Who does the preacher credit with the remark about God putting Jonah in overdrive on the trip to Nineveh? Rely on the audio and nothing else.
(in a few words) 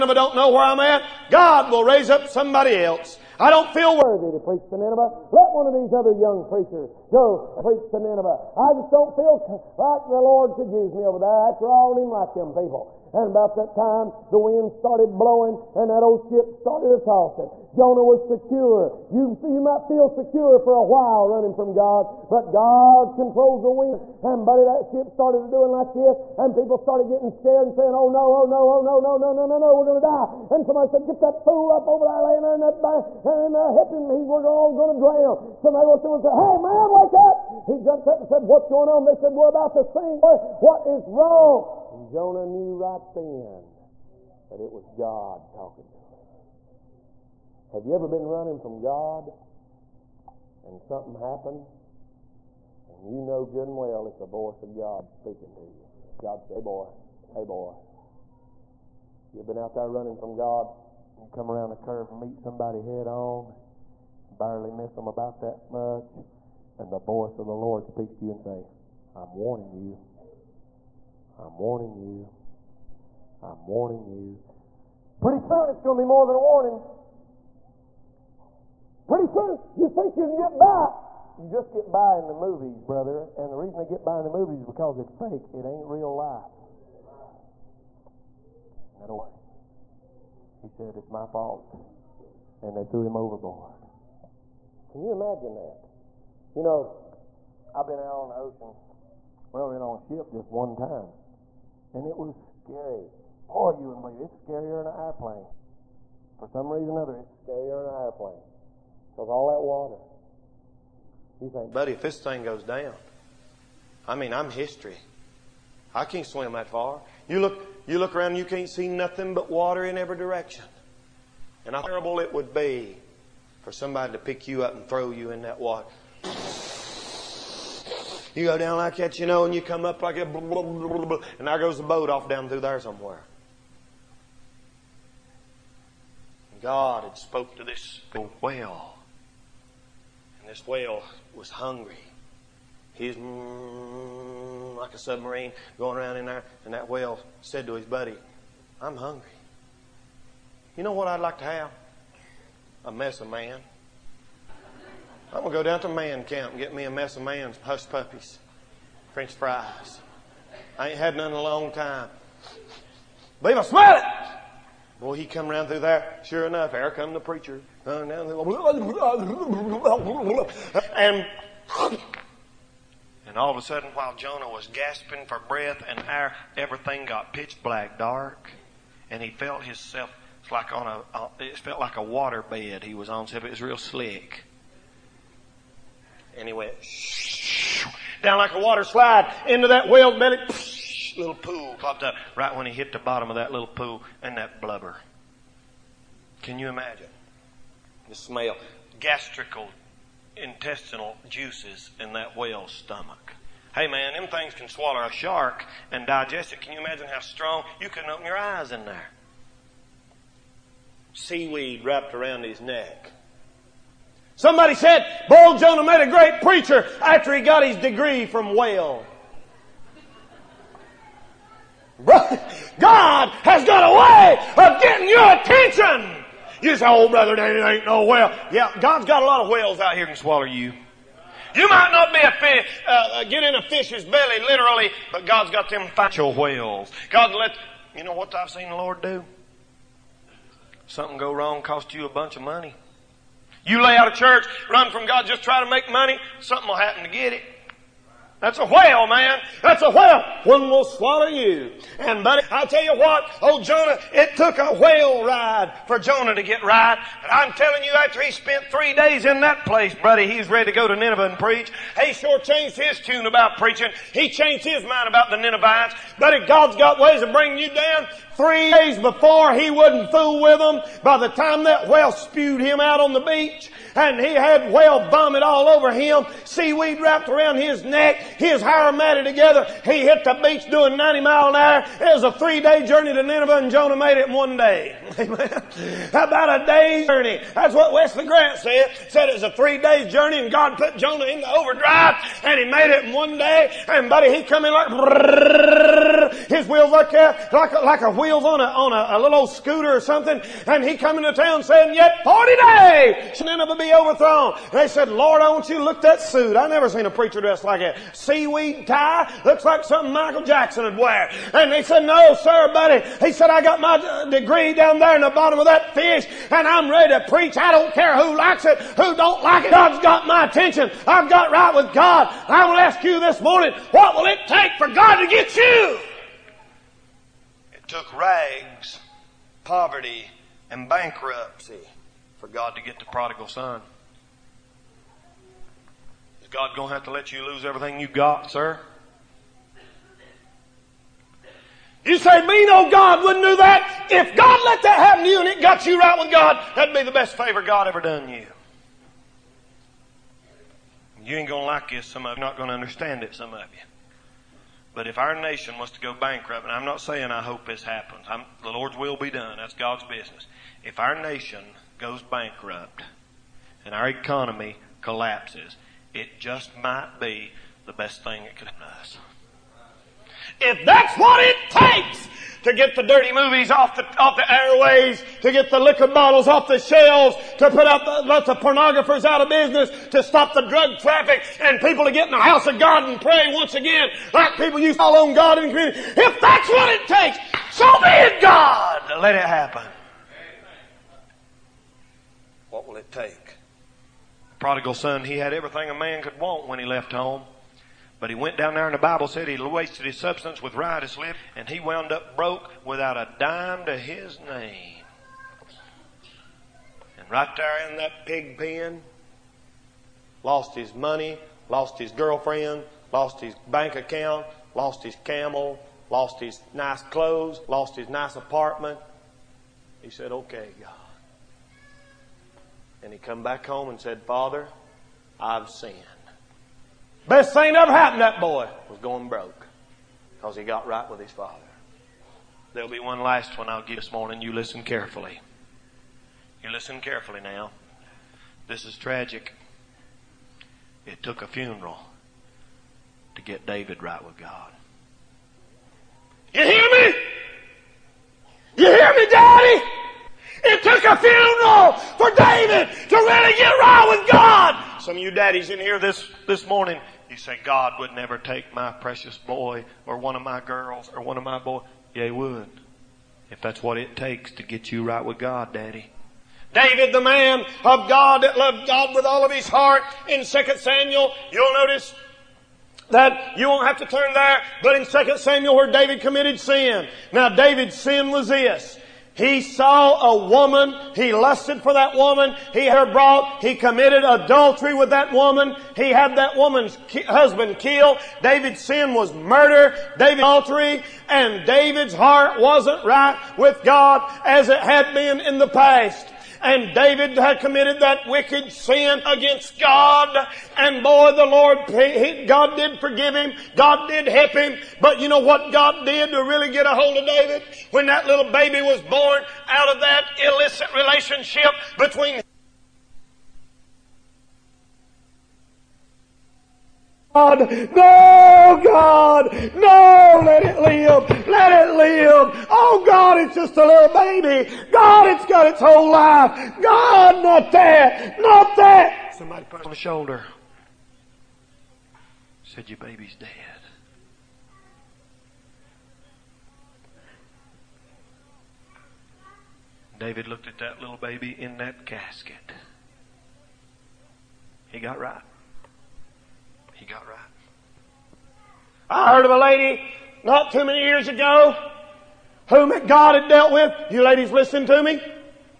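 Wesley Grant.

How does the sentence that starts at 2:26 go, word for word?
And that whale said to his buddy, I'm hungry.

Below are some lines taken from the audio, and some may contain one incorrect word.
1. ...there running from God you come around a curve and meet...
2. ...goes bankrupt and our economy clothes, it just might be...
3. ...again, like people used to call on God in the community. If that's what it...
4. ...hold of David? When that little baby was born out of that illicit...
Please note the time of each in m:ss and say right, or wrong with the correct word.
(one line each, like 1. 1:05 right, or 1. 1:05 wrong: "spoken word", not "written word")
1. 0:59 right
2. 6:01 wrong: "collapses", not "clothes"
3. 6:23 right
4. 8:26 right.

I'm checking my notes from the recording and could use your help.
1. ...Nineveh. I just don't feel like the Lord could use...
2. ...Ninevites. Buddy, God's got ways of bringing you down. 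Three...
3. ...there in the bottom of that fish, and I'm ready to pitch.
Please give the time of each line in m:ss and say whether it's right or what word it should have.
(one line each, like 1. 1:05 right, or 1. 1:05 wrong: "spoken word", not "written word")
1. 0:07 right
2. 4:25 right
3. 5:14 wrong: "preach", not "pitch".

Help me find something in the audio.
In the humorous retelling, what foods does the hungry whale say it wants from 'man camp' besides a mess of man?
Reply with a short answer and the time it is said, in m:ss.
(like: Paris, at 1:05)
hush puppies, french fries, at 2:37.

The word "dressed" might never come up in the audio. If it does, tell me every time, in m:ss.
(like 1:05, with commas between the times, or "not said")
5:07.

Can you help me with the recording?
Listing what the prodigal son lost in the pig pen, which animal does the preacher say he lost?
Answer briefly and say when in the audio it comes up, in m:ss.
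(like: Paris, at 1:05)
camel, at 6:55.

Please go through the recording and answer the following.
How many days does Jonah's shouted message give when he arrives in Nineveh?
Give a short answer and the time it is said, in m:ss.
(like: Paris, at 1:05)
40 days, at 5:02.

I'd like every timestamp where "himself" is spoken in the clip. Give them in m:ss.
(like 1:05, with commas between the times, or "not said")
2:59.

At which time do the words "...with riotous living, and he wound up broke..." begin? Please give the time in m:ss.
6:40.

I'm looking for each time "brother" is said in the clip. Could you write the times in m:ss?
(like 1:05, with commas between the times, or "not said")
1:22, 3:47.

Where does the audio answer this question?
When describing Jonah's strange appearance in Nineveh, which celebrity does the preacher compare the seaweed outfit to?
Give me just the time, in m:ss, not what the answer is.
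5:10.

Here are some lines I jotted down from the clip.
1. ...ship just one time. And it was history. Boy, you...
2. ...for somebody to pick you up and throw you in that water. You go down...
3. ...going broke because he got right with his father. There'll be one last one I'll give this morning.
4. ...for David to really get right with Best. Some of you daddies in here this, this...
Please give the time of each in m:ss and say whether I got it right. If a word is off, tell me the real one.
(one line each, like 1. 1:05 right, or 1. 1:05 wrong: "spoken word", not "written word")
1. 1:39 wrong: "scary", not "history"
2. 2:03 right
3. 7:08 right
4. 7:32 wrong: "God", not "Best".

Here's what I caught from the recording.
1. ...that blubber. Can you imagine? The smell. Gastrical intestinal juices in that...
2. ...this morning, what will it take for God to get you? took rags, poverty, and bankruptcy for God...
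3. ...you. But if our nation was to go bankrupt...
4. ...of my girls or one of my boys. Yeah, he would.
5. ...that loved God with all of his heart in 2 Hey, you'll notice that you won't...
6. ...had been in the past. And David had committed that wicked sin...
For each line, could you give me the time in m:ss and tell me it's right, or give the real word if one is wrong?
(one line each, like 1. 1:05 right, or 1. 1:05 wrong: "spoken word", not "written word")
1. 3:14 right
2. 5:23 right
3. 5:53 right
4. 7:40 right
5. 7:48 wrong: "Samuel", not "Hey"
6. 8:14 right.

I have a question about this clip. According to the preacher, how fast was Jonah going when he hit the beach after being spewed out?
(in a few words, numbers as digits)
90 mile an hour.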